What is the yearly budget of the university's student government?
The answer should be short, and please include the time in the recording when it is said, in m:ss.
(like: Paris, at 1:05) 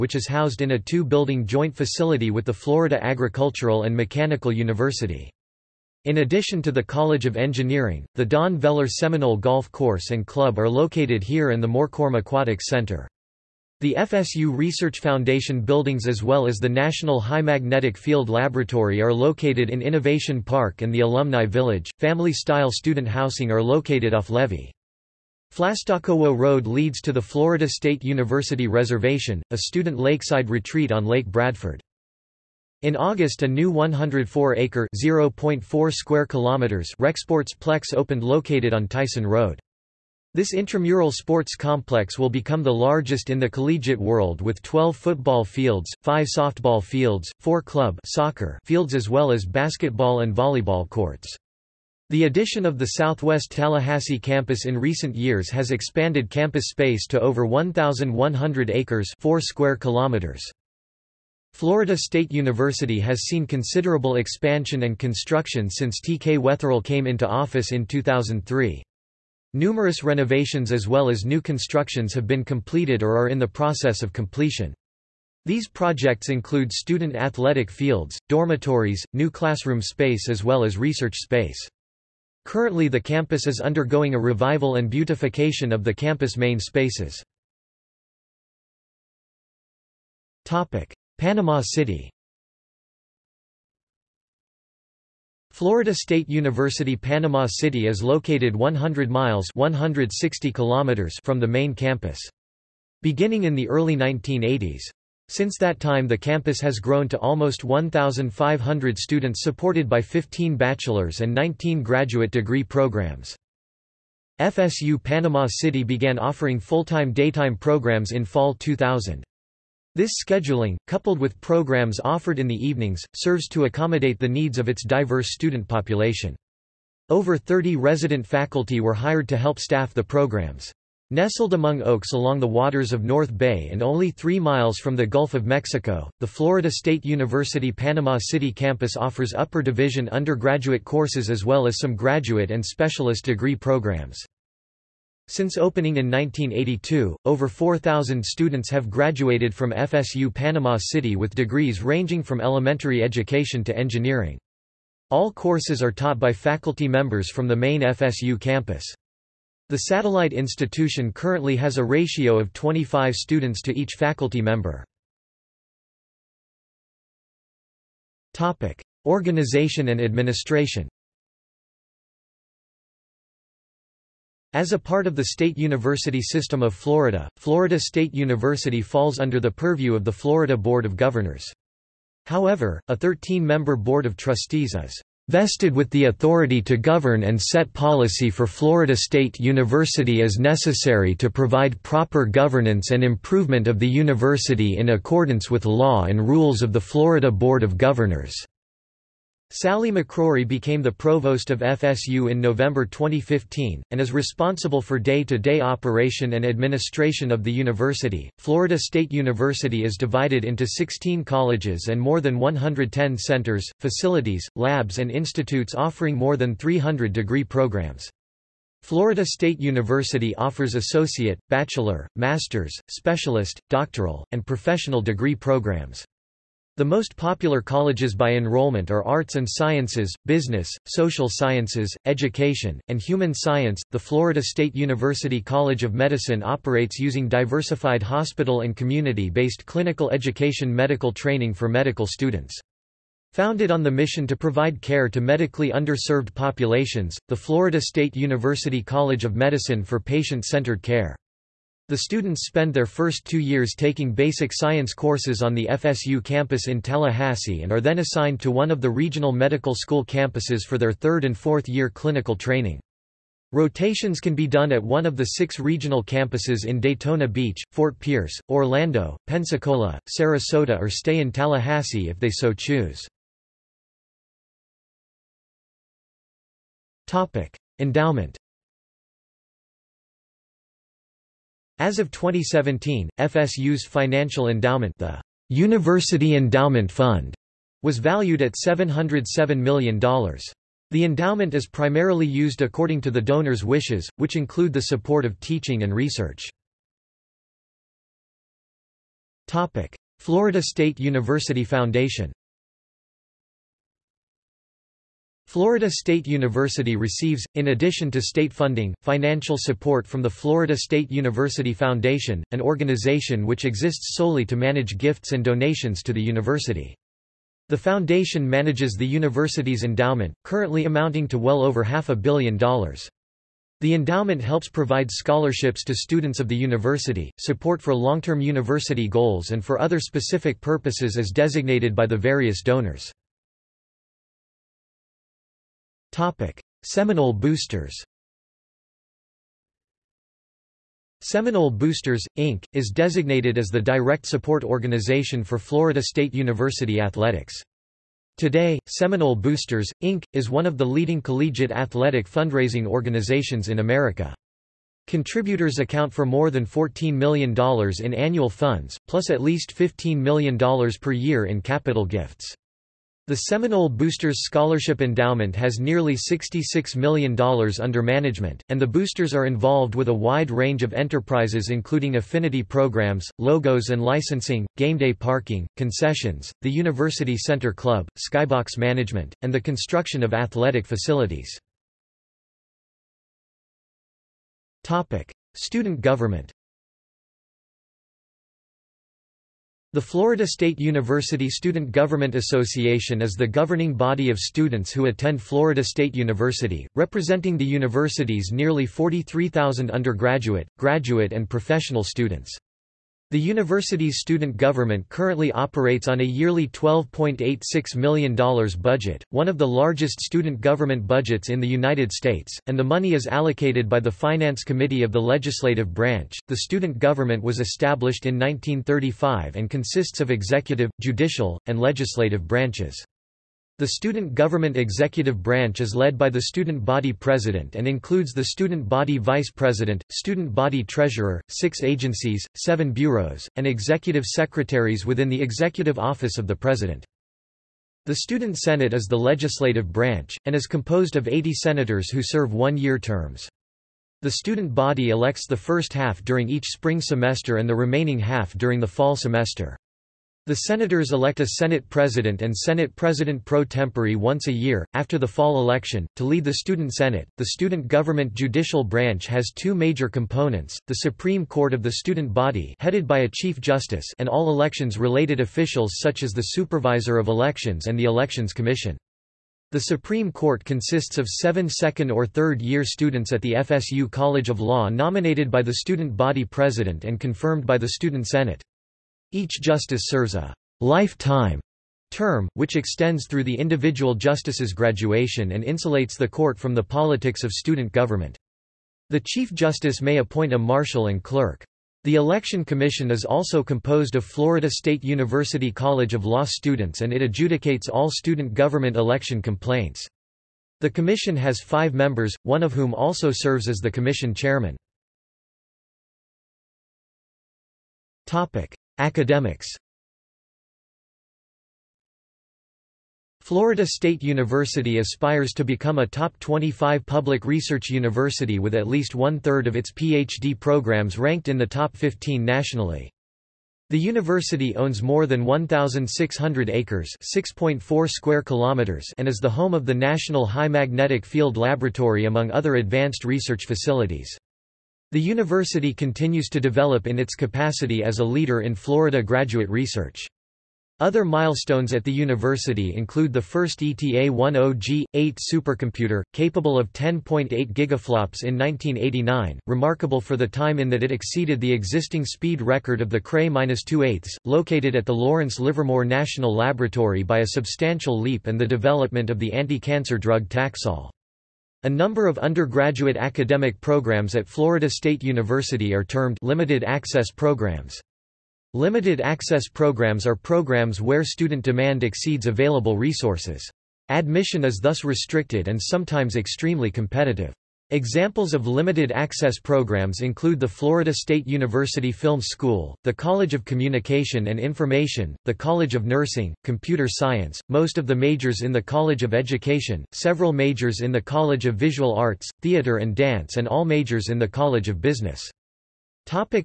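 $12.86 million, at 6:46.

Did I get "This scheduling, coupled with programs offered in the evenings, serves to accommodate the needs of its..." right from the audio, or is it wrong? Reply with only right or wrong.
right.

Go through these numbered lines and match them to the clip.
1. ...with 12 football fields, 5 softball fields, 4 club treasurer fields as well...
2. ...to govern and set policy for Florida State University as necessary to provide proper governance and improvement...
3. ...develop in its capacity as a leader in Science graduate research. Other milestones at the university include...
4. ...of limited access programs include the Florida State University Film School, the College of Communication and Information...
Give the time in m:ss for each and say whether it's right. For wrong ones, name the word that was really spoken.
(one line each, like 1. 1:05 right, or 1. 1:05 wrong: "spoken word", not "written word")
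1. 0:44 wrong: "soccer", not "treasurer"
2. 3:06 right
3. 8:56 wrong: "Florida", not "Science"
4. 9:38 right.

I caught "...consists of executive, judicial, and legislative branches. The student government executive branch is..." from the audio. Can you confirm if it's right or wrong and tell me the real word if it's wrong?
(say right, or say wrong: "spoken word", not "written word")
right.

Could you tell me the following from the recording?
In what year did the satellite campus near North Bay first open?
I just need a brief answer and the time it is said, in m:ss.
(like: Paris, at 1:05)
1982, at 2:26.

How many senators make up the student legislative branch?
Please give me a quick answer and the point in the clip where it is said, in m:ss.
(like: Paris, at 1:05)
80, at 7:21.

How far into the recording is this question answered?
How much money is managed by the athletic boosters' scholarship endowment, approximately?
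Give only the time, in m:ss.
6:06.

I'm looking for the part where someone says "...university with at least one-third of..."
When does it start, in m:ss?
8:37.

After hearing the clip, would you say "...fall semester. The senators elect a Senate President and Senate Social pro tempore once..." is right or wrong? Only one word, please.
wrong.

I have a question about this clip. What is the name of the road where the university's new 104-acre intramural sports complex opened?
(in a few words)
Tyson Road.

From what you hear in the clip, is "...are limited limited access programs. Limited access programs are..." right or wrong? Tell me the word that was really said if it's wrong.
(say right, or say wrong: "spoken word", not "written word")
wrong: "termed", not "limited".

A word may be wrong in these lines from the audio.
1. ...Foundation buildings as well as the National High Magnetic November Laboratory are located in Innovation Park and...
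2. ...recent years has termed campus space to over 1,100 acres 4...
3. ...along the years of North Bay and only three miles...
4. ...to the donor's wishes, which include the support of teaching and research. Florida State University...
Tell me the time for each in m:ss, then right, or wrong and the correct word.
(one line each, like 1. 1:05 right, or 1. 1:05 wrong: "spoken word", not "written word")
1. 0:14 wrong: "Field", not "November"
2. 0:54 wrong: "expanded", not "termed"
3. 2:12 wrong: "waters", not "years"
4. 4:53 right.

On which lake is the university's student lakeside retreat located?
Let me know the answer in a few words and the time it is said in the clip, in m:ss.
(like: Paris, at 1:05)
Lake Bradford, at 0:31.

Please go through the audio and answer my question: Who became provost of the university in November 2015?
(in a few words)
Sally McRorie.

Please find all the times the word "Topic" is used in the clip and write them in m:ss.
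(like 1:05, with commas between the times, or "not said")
2:48, 5:36.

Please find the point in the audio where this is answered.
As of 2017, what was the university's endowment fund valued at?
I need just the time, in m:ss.
4:48.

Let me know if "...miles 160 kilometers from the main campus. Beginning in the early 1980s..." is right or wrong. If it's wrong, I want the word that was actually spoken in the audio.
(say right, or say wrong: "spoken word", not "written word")
right.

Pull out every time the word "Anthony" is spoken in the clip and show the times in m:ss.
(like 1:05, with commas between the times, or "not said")
not said.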